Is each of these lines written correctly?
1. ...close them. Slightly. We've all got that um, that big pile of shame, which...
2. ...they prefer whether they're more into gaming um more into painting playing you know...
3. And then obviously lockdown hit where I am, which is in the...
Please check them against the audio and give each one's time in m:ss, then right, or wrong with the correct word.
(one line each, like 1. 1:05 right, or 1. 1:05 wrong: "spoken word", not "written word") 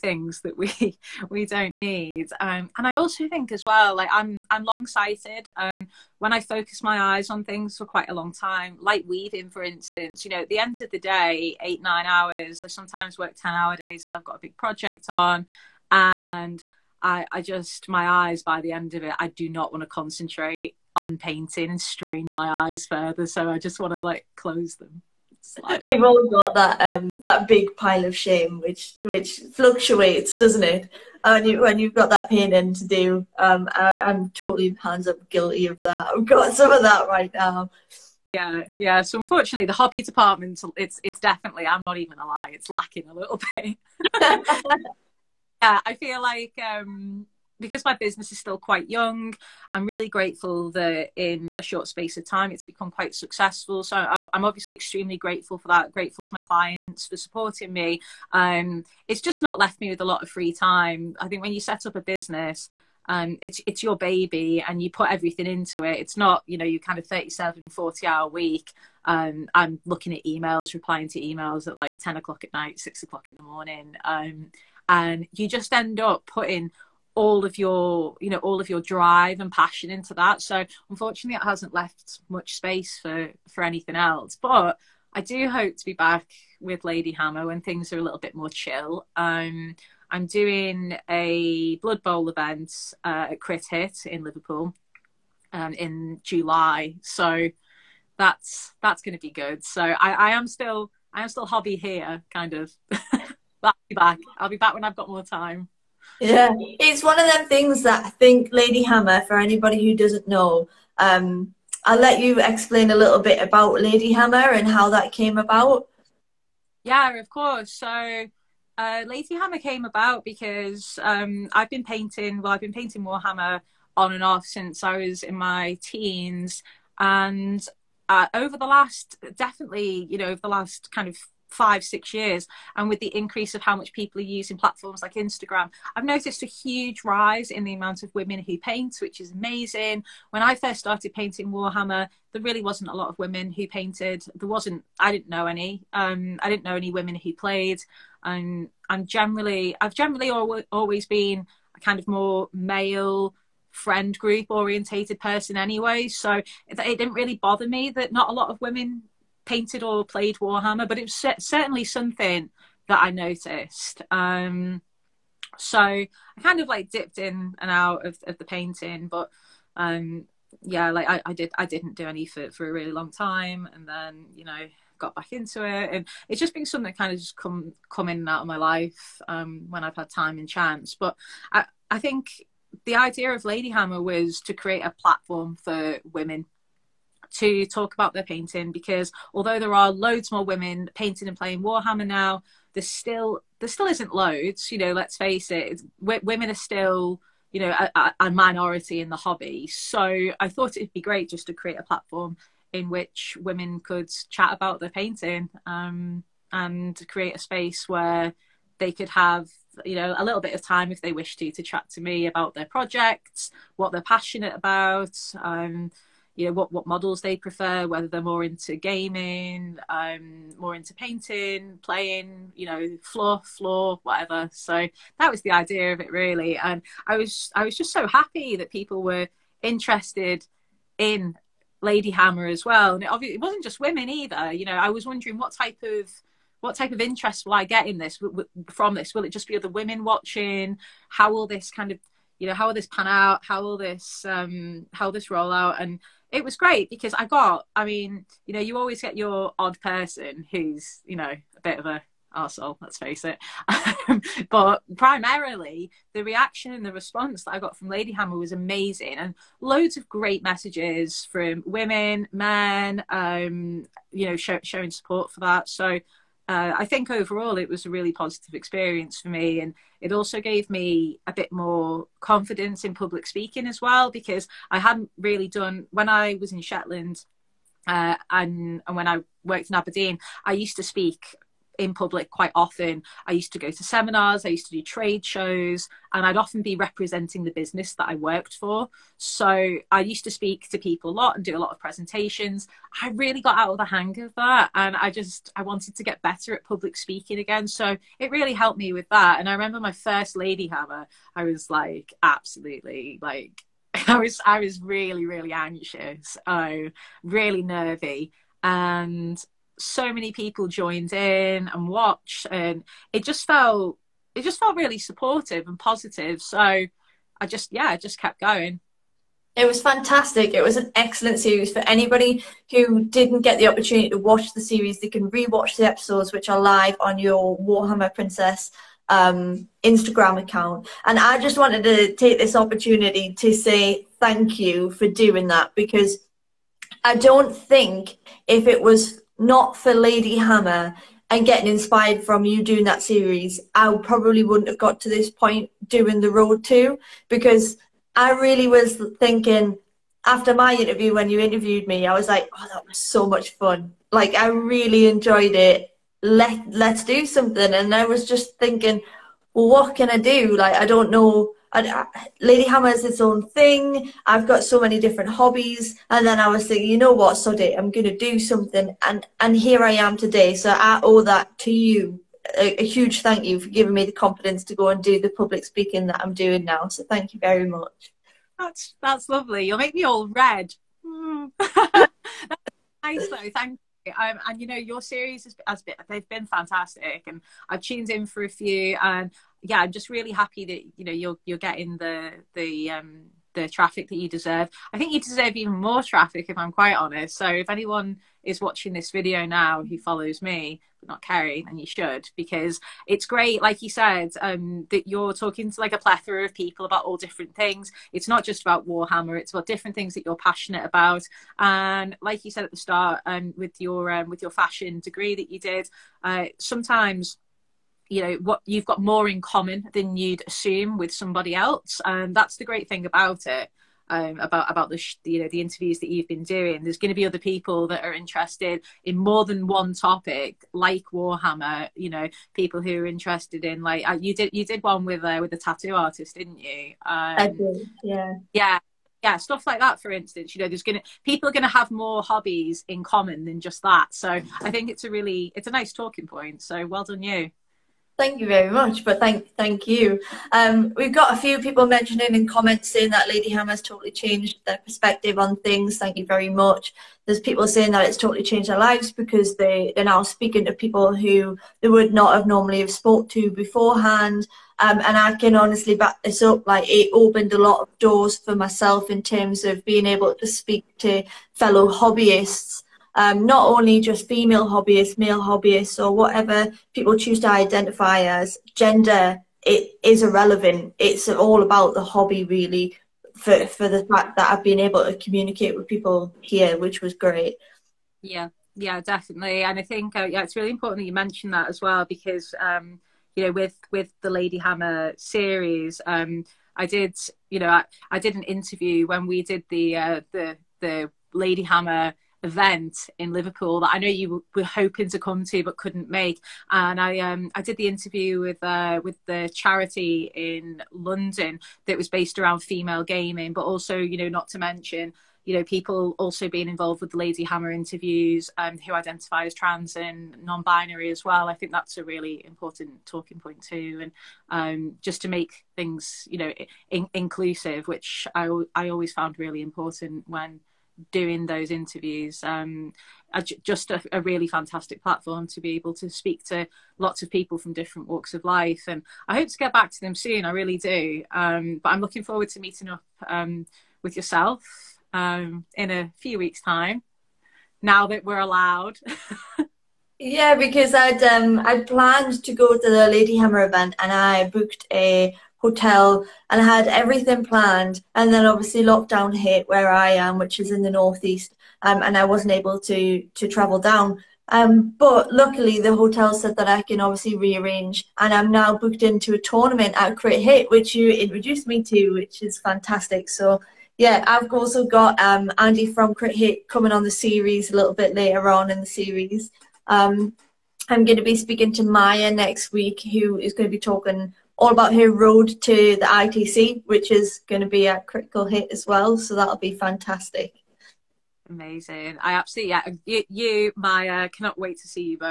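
1. 0:24 right
2. 3:37 right
3. 9:18 right.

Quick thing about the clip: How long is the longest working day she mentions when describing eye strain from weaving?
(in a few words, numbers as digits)
10 hour days.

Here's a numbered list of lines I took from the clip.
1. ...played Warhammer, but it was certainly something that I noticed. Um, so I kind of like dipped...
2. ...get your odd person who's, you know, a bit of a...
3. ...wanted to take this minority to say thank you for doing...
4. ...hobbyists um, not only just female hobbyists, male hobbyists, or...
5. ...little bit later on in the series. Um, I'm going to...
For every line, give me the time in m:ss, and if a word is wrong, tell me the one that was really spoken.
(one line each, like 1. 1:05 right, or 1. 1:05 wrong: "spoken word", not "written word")
1. 2:40 right
2. 4:09 right
3. 5:31 wrong: "opportunity", not "minority"
4. 7:51 right
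5. 9:37 right.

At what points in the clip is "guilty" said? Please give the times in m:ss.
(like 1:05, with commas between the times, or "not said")
0:35.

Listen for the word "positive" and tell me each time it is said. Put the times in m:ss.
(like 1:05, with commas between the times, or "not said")
4:28, 5:15.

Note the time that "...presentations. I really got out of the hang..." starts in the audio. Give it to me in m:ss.
4:51.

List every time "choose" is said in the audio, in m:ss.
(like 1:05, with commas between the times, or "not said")
7:57.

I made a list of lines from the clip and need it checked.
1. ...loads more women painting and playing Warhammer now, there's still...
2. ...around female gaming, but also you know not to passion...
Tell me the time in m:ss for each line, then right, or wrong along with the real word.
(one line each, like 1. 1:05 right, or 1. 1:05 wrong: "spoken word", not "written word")
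1. 3:09 right
2. 8:32 wrong: "mention", not "passion".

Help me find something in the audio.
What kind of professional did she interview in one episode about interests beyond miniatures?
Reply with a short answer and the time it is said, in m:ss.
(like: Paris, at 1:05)
a tattoo artist, at 7:15.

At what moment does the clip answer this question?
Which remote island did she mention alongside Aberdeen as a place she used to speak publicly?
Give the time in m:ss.
4:36.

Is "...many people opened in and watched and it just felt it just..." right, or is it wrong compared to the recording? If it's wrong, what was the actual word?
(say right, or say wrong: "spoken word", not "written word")
wrong: "joined", not "opened".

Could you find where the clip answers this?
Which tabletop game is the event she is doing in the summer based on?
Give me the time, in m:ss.
1:31.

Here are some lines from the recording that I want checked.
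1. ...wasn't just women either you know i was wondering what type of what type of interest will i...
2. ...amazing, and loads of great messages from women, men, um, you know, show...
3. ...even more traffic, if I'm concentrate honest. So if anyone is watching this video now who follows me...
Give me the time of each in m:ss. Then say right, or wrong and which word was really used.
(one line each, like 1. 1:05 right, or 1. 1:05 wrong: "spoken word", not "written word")
1. 3:53 right
2. 4:18 right
3. 6:35 wrong: "quite", not "concentrate".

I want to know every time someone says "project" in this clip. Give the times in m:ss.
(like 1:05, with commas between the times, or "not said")
0:14, 3:32.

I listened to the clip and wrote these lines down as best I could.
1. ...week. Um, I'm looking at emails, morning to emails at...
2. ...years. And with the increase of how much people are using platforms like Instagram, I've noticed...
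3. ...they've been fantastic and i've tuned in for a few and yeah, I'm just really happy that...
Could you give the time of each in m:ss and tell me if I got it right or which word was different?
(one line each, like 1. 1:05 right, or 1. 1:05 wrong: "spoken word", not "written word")
1. 1:08 wrong: "replying", not "morning"
2. 2:12 right
3. 6:26 right.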